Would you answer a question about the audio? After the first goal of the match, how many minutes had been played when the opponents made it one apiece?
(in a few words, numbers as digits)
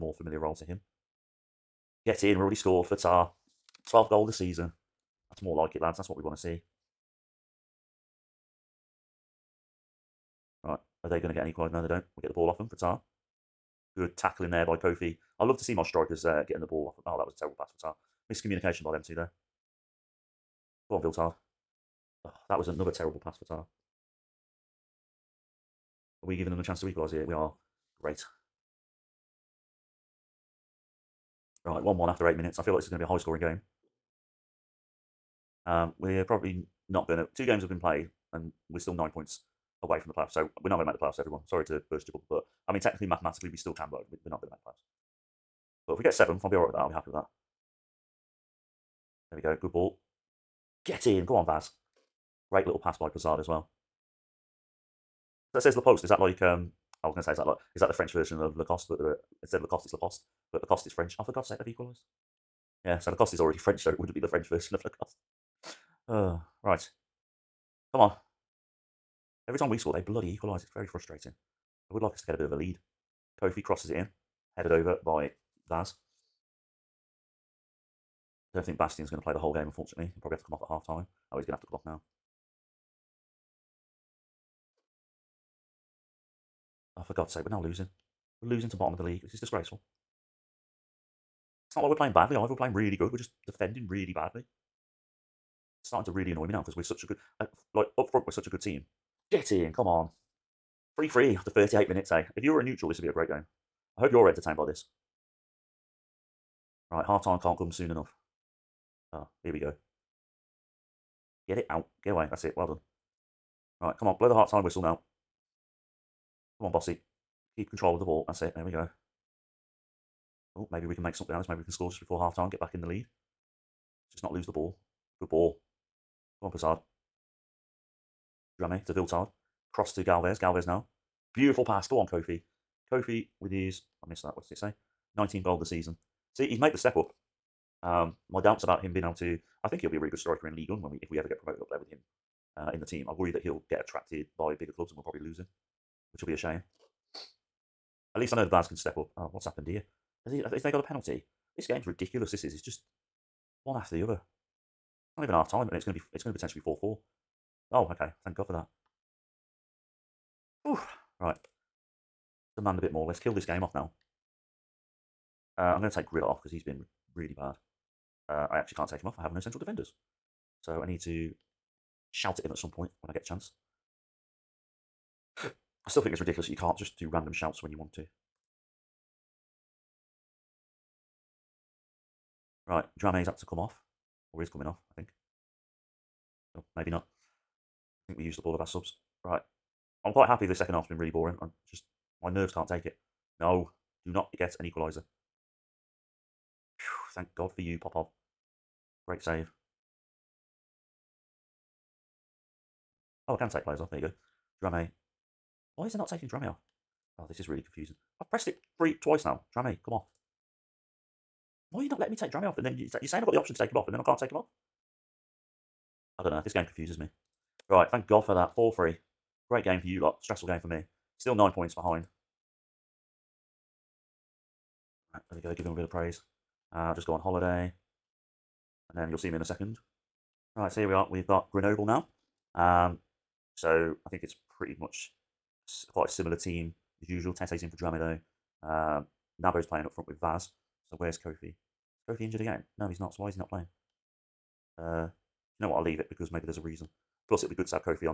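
8.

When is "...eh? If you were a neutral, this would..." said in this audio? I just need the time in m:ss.
1:42.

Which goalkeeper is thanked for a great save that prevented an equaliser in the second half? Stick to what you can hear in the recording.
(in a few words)
Popov.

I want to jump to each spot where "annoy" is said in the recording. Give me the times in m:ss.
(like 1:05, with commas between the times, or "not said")
1:36.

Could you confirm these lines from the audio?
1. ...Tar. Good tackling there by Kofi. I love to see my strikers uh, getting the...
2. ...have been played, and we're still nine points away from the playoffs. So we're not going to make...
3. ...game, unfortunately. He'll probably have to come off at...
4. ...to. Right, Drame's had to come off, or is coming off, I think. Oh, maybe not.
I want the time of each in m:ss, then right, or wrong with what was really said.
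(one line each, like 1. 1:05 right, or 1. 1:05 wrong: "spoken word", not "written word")
1. 0:12 right
2. 0:37 right
3. 1:19 right
4. 2:57 right.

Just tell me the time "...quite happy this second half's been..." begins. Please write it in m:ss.
3:10.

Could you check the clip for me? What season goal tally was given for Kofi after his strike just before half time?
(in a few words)
19.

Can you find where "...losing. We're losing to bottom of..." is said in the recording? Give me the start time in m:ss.
1:27.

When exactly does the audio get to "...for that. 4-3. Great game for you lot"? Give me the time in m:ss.
3:38.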